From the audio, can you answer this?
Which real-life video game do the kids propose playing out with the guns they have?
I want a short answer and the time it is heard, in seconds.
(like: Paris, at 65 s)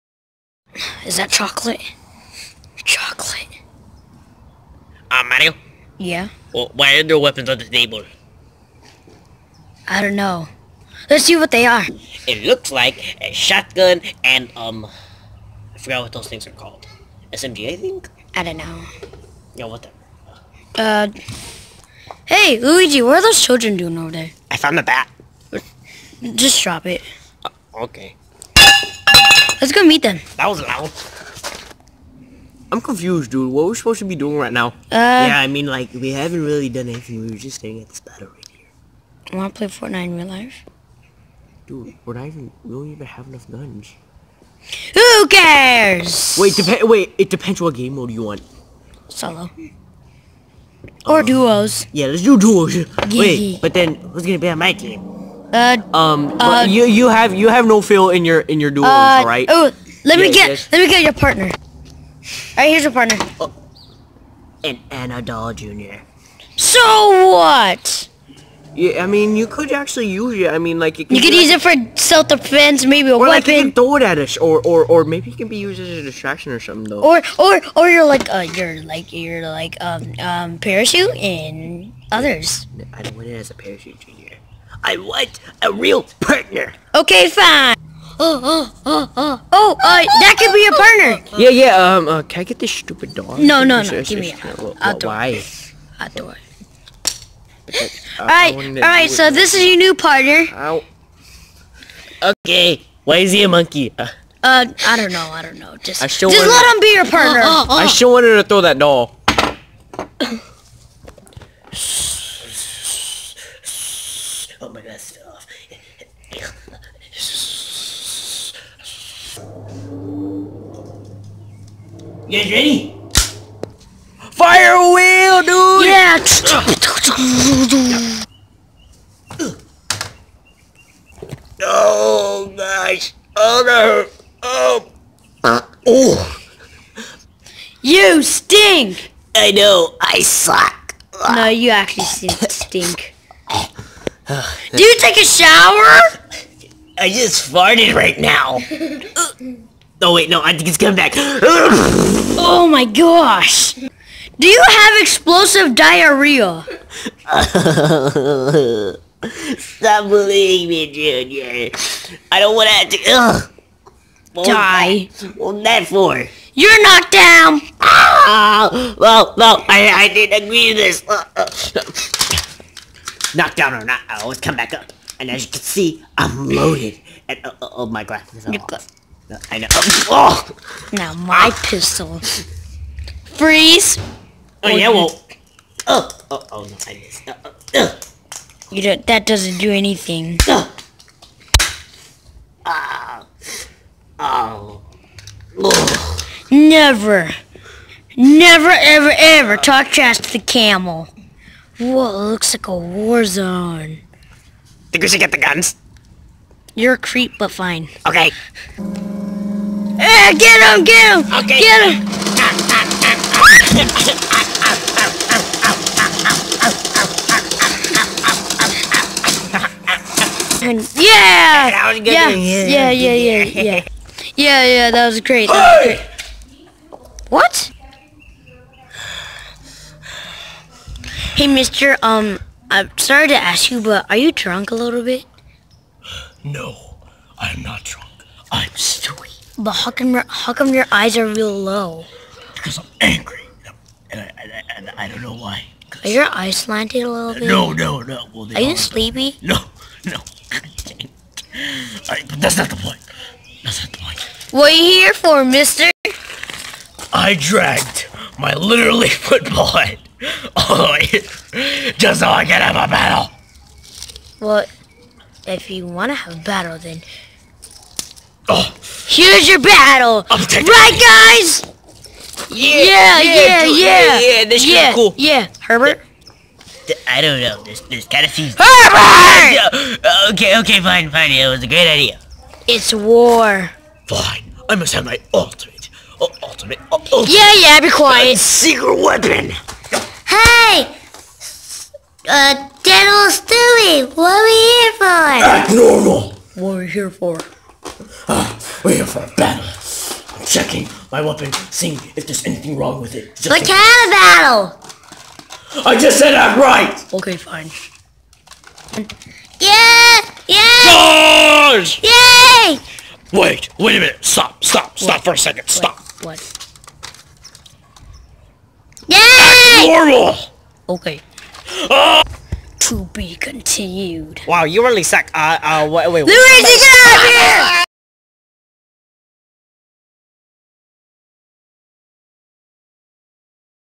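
Fortnite, at 39 s.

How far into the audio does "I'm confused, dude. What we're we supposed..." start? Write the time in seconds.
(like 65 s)
32 s.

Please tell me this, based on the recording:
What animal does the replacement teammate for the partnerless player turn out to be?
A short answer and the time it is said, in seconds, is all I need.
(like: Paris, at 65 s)
monkey, at 103 s.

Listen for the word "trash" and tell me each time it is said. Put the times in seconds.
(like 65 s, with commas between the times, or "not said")
199 s.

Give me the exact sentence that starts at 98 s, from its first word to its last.
Alright, alright, so this is your new partner.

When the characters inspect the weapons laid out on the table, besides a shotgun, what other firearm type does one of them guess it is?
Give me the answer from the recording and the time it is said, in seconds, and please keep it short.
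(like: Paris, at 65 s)
SMG, at 17 s.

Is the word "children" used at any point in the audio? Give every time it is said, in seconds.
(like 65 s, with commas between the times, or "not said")
23 s.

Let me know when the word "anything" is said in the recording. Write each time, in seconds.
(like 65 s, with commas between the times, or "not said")
36 s, 189 s, 302 s.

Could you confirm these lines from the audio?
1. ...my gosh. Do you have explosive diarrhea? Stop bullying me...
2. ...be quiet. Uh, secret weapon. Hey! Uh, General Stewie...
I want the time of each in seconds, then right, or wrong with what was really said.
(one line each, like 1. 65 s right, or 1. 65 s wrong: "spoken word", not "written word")
1. 152 s right
2. 287 s right.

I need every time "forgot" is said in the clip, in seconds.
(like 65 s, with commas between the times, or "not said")
15 s.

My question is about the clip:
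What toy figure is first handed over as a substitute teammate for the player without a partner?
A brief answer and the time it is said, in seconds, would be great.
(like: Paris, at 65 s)
An Doll Jr., at 64 s.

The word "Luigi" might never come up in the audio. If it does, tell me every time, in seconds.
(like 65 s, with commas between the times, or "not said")
22 s, 326 s.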